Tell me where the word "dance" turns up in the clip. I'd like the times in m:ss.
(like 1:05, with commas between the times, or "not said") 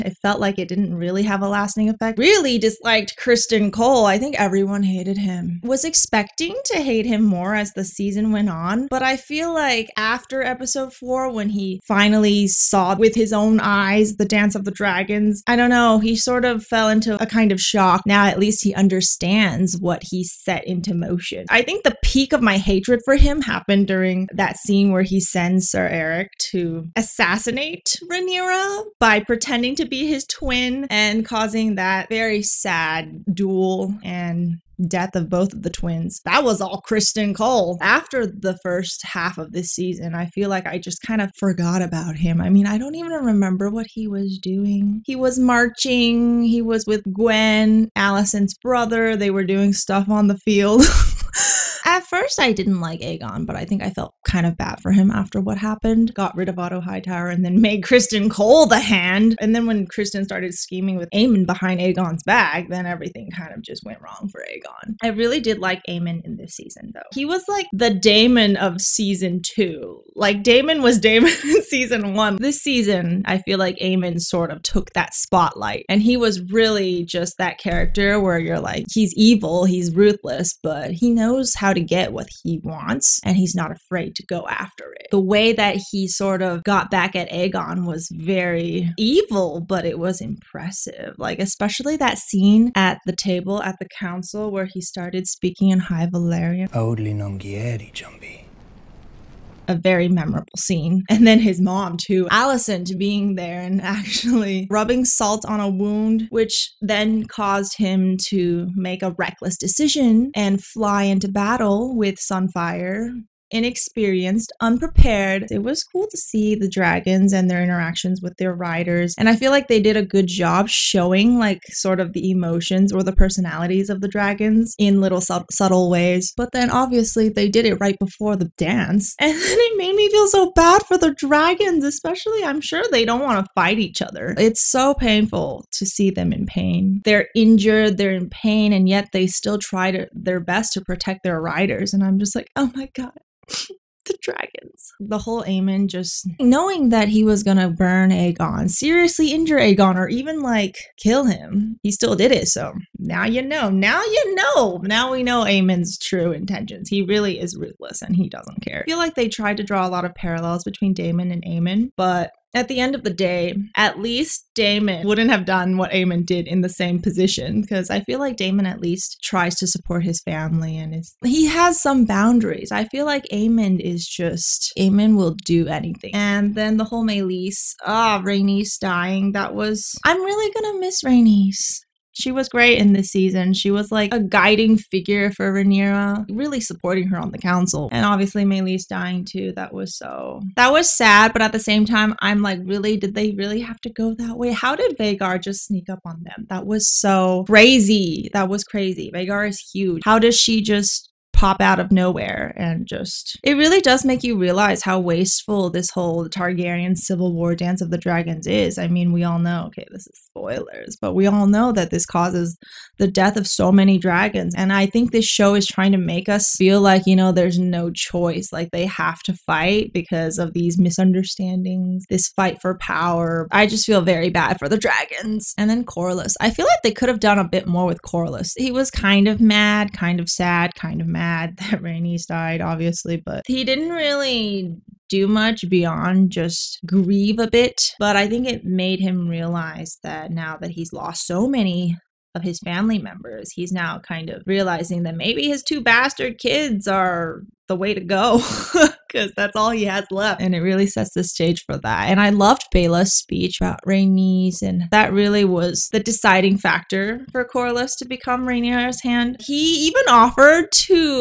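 0:14, 2:08, 3:27.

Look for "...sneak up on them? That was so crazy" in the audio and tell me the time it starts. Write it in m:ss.
3:15.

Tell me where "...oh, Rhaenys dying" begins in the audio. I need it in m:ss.
2:58.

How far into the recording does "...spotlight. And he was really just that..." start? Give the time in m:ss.
1:15.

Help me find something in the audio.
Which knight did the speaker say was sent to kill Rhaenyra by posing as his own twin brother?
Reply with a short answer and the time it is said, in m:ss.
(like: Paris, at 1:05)
Sir Erryk, at 0:25.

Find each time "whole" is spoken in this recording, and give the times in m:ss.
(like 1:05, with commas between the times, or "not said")
2:25, 2:56, 3:25.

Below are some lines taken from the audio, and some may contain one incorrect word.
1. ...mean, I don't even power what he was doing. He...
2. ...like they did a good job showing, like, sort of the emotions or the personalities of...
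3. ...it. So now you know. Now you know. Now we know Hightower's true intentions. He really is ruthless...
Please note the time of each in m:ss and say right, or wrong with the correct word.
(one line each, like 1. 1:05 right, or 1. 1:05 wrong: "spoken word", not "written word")
1. 0:42 wrong: "remember", not "power"
2. 1:59 right
3. 2:32 wrong: "Aemond", not "Hightower".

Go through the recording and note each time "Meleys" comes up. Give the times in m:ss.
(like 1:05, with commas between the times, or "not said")
2:57, 3:08.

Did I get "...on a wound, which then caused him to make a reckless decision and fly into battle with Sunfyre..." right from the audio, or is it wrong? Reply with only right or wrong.
right.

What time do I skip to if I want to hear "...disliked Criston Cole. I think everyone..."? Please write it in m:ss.
0:02.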